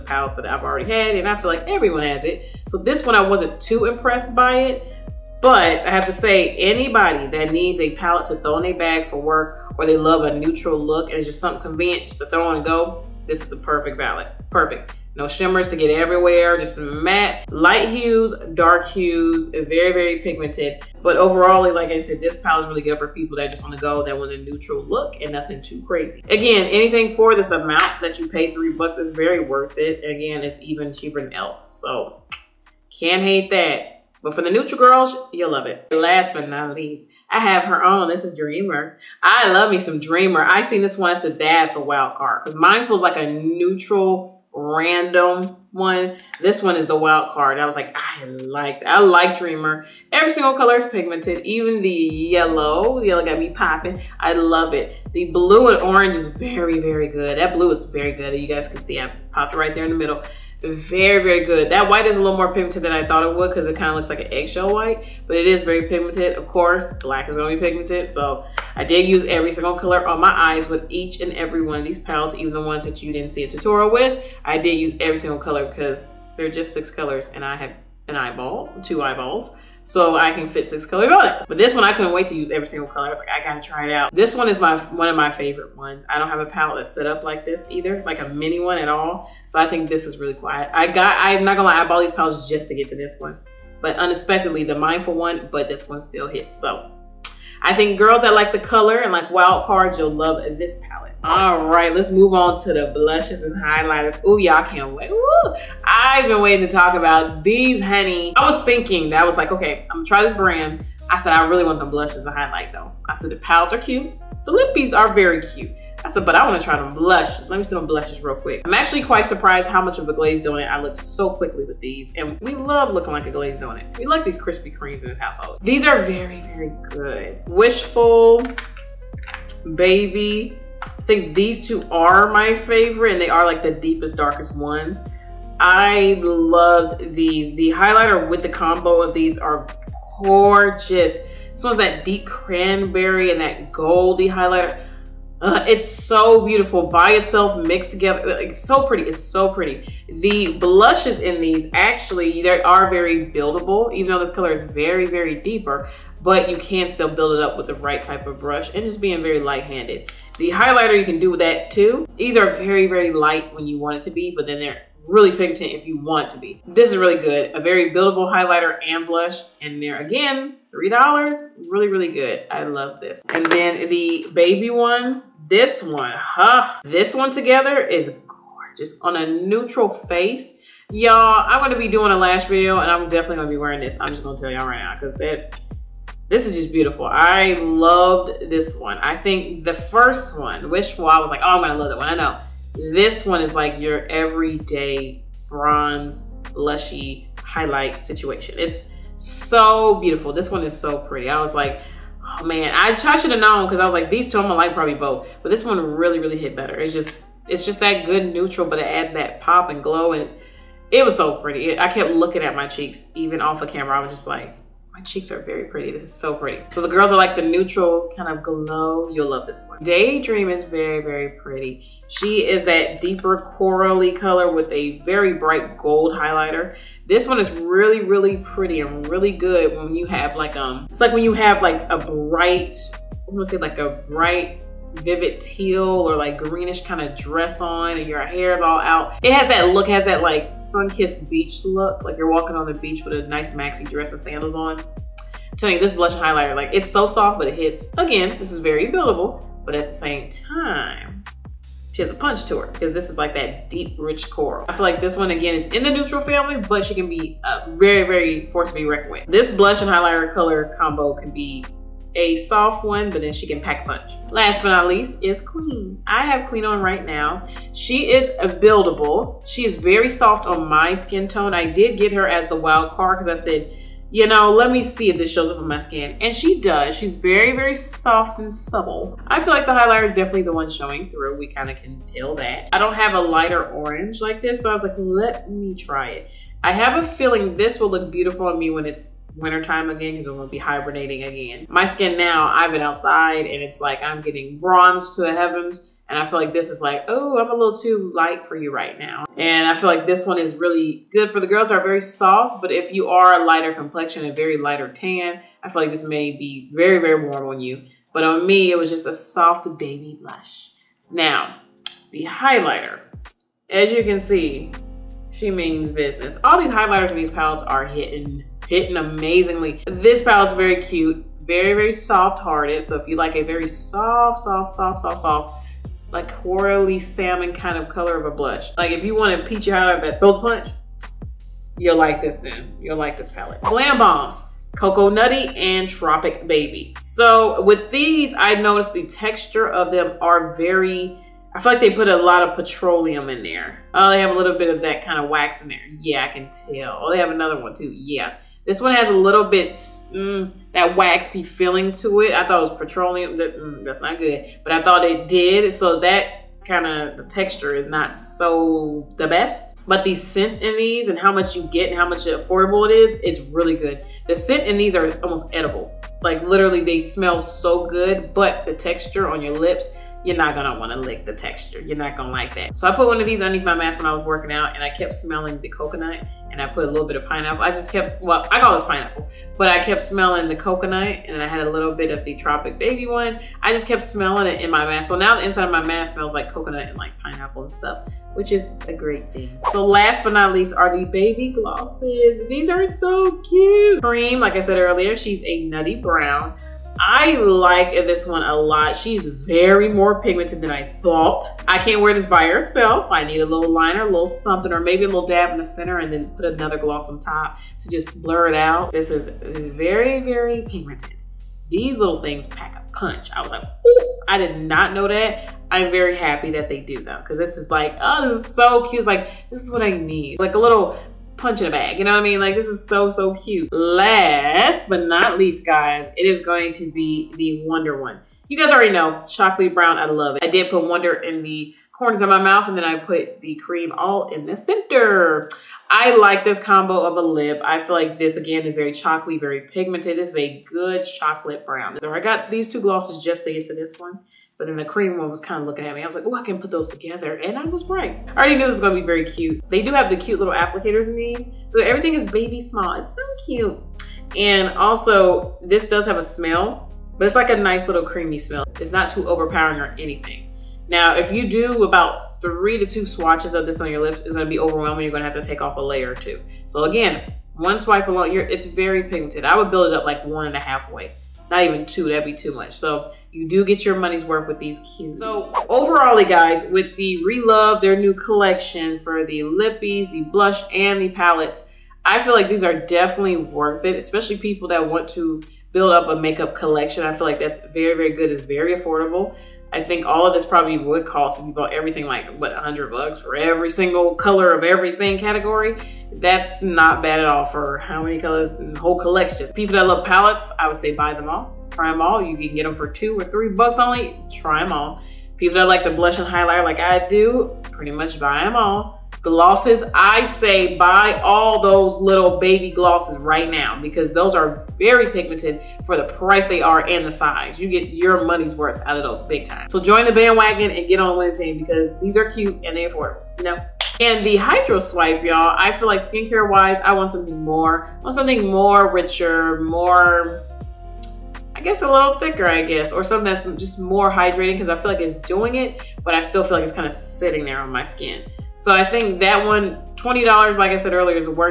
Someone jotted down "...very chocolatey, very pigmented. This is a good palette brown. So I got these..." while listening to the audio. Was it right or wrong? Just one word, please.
wrong.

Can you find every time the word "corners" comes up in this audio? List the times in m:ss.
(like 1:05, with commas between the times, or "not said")
7:11.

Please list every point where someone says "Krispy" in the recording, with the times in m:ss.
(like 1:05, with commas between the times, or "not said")
2:04.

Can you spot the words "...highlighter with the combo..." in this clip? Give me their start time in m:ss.
2:17.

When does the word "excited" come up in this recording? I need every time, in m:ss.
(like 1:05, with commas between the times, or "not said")
not said.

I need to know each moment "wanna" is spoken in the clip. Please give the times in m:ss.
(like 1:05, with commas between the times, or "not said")
1:56, 6:10.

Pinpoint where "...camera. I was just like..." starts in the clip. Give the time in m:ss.
3:33.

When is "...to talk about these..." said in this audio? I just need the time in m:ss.
1:46.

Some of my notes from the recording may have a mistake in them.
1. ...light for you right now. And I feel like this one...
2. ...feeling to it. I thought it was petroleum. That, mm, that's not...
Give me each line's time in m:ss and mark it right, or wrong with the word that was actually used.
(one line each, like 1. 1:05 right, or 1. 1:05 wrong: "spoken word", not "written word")
1. 4:58 right
2. 5:51 right.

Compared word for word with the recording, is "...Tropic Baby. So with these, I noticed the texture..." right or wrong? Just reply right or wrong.
right.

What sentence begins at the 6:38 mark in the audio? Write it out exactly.
She's very more pigmented than I thought.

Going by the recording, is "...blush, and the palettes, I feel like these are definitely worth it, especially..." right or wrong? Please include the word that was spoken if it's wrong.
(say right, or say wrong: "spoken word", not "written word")
right.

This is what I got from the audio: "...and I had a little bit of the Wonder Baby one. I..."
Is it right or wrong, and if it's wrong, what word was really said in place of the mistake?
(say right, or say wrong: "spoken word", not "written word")
wrong: "Tropic", not "Wonder".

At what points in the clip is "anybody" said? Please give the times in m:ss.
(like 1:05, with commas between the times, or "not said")
0:06.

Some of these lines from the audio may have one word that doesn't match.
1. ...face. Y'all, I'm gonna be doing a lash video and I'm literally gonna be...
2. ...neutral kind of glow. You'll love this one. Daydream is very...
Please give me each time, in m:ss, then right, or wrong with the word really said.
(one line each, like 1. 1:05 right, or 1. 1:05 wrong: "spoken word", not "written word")
1. 2:59 wrong: "definitely", not "literally"
2. 3:37 right.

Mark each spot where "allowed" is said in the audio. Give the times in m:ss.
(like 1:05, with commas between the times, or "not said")
not said.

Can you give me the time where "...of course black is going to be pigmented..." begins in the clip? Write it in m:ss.
1:06.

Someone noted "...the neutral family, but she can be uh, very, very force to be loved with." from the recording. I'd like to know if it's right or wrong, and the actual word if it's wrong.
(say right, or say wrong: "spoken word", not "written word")
wrong: "reckoned", not "loved".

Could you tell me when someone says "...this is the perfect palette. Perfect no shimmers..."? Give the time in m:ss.
0:13.